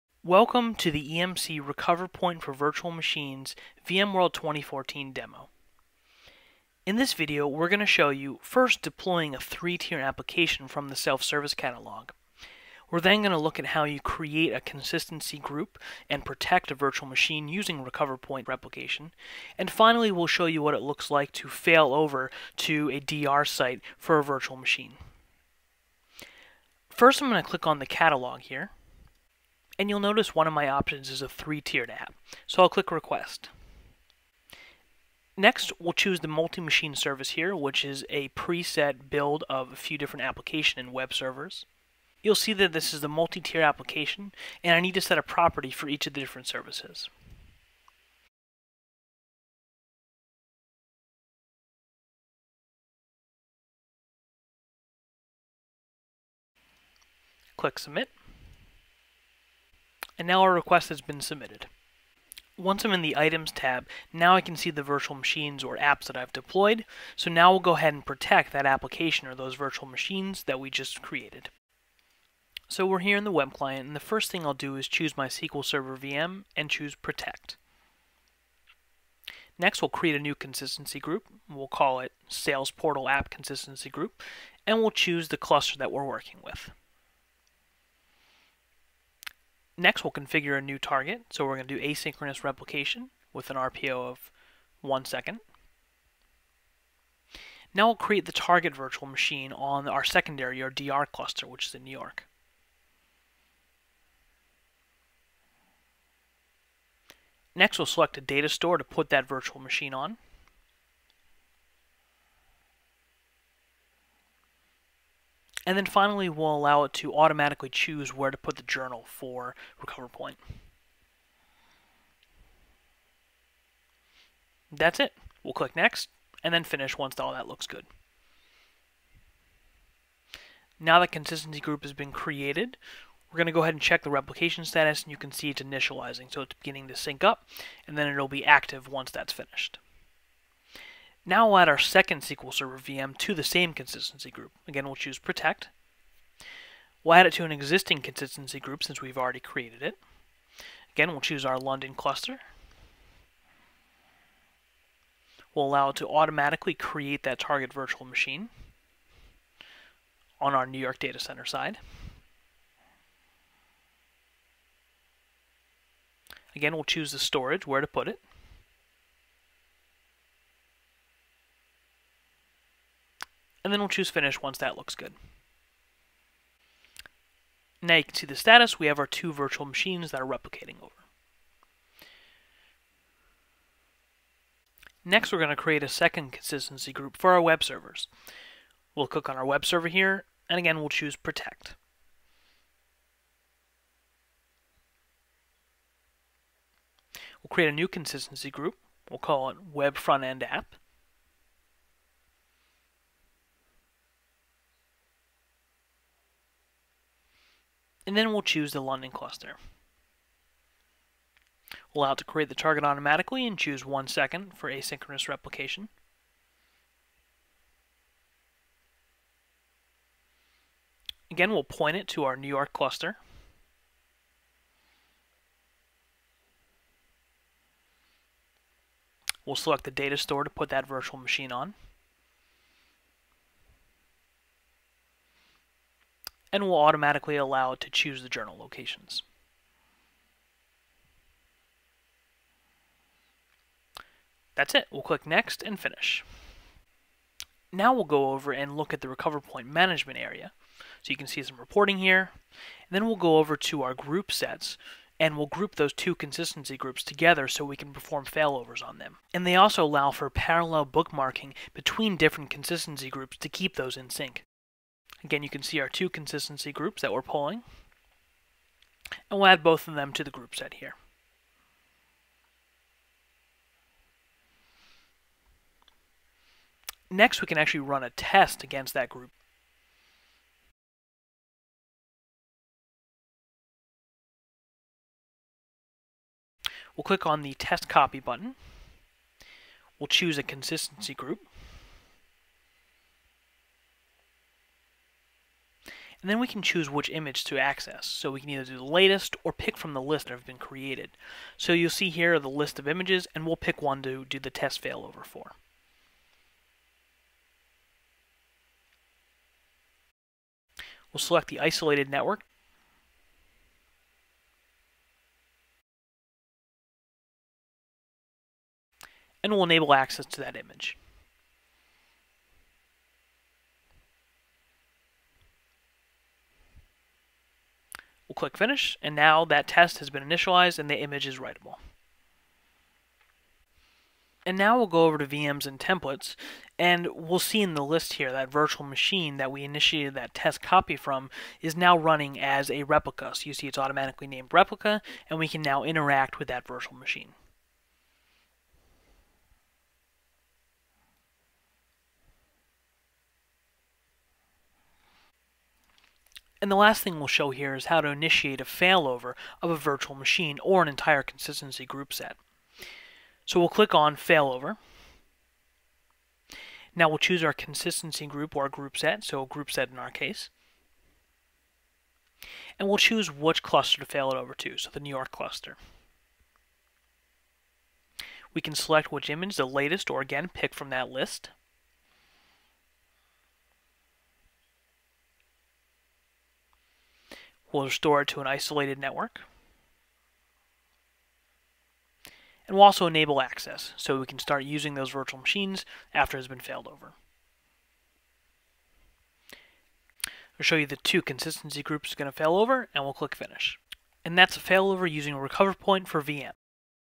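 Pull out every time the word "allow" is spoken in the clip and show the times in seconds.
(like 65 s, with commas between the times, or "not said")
116 s, 155 s, 212 s, 237 s, 259 s.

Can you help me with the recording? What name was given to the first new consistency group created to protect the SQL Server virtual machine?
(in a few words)
Sales Portal App Consistency Group.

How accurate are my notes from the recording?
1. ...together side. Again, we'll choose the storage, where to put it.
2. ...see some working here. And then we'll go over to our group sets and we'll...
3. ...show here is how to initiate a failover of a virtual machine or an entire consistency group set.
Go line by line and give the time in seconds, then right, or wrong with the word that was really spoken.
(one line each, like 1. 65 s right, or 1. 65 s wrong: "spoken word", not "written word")
1. 161 s wrong: "center", not "together"
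2. 251 s wrong: "reporting", not "working"
3. 357 s right.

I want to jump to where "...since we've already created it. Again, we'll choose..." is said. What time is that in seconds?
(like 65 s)
148 s.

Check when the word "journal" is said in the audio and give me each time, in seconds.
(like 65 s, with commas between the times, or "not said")
118 s, 238 s.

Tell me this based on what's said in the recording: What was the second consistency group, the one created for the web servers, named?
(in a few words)
Web Front End App.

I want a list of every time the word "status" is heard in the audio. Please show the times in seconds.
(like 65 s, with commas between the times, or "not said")
134 s, 178 s.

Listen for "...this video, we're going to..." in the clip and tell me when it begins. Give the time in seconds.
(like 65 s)
6 s.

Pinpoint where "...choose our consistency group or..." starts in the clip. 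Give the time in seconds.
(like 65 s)
367 s.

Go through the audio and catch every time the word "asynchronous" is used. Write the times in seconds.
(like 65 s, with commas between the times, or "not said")
91 s, 214 s.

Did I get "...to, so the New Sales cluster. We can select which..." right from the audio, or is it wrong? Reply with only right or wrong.
wrong.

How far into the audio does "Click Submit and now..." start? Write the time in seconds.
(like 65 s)
57 s.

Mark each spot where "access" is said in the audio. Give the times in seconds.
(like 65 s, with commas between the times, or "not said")
297 s, 319 s, 393 s.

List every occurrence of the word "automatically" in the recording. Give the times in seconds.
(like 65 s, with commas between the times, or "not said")
117 s, 156 s, 212 s, 236 s, 343 s.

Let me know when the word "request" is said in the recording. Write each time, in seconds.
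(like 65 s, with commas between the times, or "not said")
32 s, 60 s.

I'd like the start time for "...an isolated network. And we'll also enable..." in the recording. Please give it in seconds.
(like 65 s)
388 s.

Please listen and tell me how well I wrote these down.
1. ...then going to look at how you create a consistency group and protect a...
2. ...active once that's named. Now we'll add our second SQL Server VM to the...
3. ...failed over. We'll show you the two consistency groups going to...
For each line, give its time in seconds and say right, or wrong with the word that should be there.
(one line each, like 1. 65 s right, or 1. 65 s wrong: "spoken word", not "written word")
1. 12 s right
2. 138 s wrong: "finished", not "named"
3. 396 s right.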